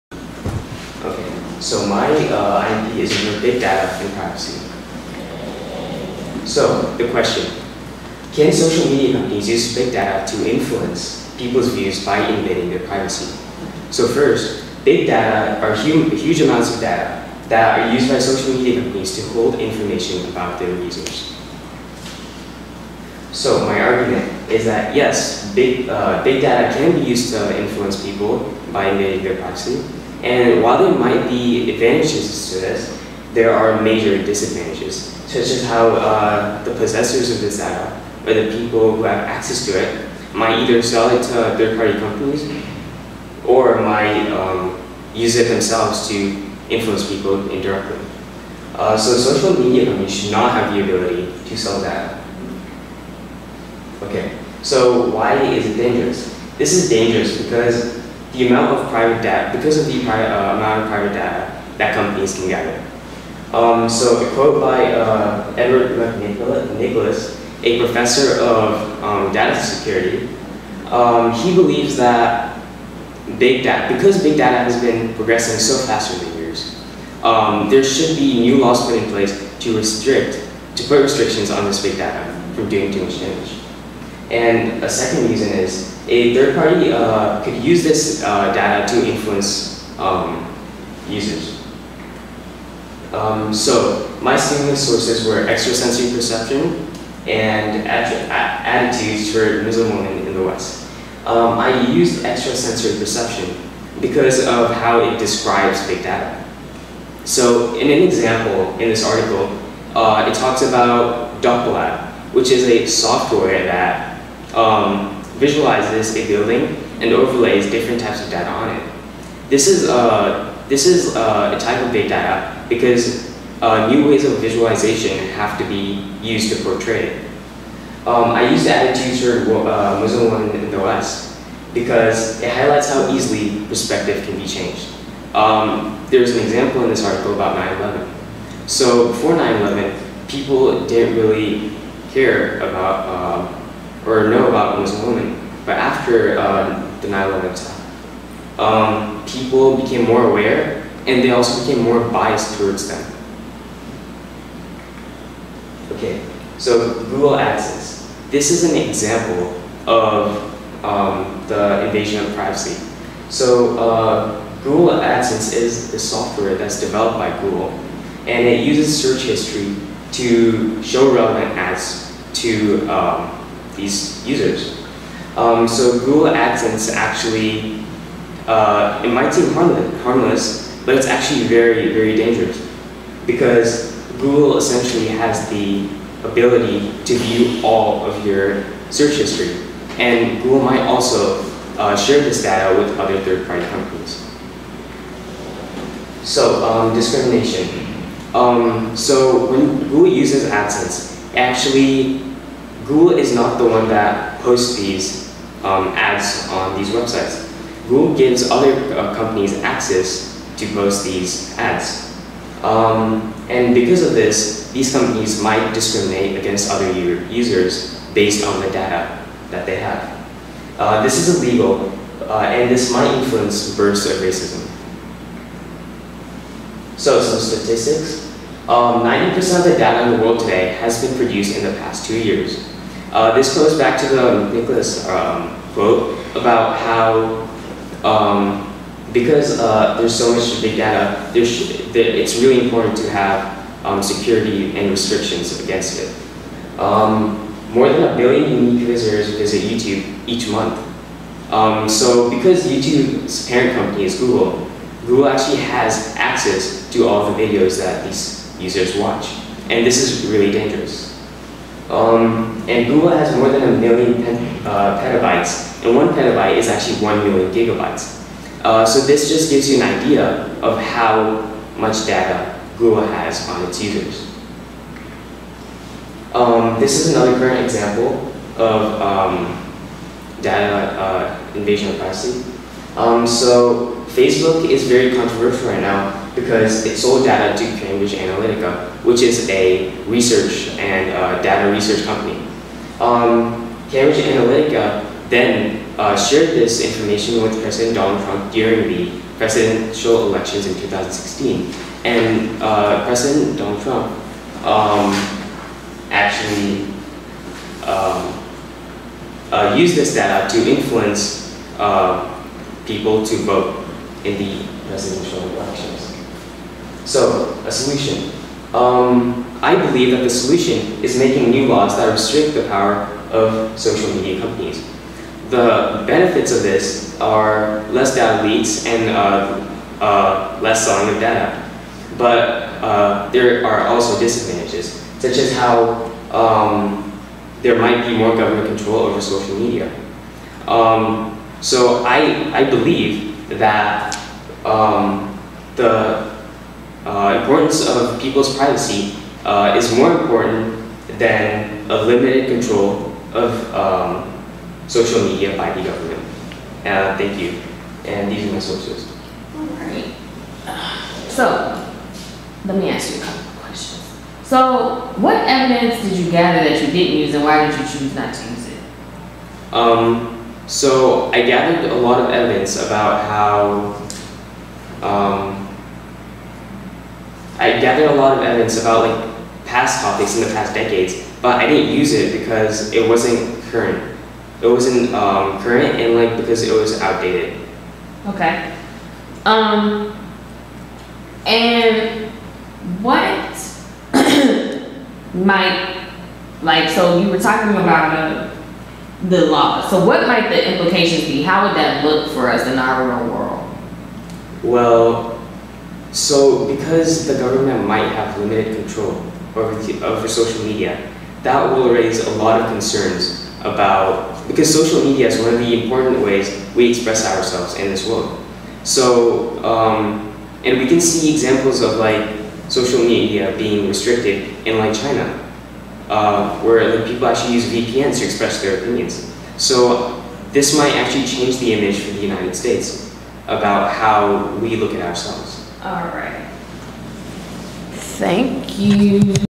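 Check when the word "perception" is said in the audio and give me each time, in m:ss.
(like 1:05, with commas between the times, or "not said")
1:36, 1:42.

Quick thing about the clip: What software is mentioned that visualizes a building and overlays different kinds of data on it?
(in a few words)
DuckLab.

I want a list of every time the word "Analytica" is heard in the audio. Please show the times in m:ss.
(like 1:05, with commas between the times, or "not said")
4:48, 4:54.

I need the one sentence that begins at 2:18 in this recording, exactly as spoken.
So before 9-11, people didn't really care about uh, or know about him as a woman.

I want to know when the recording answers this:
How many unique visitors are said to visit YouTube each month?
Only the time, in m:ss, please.
4:07.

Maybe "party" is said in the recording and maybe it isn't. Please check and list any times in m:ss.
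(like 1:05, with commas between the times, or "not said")
0:41, 1:26, 3:13.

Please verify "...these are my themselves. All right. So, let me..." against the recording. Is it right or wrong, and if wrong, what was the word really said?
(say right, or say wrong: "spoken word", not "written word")
wrong: "sources", not "themselves".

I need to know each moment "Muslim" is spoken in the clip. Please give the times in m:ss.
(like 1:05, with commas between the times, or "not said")
1:39, 2:09.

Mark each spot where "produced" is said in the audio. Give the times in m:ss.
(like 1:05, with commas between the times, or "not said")
3:51.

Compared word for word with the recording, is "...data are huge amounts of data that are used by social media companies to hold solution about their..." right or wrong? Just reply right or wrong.
wrong.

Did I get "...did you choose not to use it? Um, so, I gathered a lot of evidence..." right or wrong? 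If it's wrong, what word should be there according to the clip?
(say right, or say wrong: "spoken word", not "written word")
right.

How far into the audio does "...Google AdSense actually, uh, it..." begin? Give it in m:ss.
2:55.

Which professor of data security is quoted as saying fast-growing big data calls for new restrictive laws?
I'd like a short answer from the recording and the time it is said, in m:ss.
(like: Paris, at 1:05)
Edward McNicholas, at 1:05.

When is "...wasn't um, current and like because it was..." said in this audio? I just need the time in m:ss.
6:24.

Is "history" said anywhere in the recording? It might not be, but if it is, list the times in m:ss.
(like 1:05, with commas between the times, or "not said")
2:49, 3:09.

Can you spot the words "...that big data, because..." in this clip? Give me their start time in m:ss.
1:11.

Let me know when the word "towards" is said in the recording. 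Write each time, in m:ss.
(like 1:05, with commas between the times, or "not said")
2:32.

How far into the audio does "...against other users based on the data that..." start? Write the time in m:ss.
3:36.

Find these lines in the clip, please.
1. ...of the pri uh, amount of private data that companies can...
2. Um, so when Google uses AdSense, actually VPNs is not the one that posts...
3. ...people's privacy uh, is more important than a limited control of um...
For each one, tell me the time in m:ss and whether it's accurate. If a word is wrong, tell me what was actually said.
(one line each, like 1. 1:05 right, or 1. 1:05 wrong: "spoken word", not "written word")
1. 0:59 right
2. 3:18 wrong: "Google", not "VPNs"
3. 5:48 right.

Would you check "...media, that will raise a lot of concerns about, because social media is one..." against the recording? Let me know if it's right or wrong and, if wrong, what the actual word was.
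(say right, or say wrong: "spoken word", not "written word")
right.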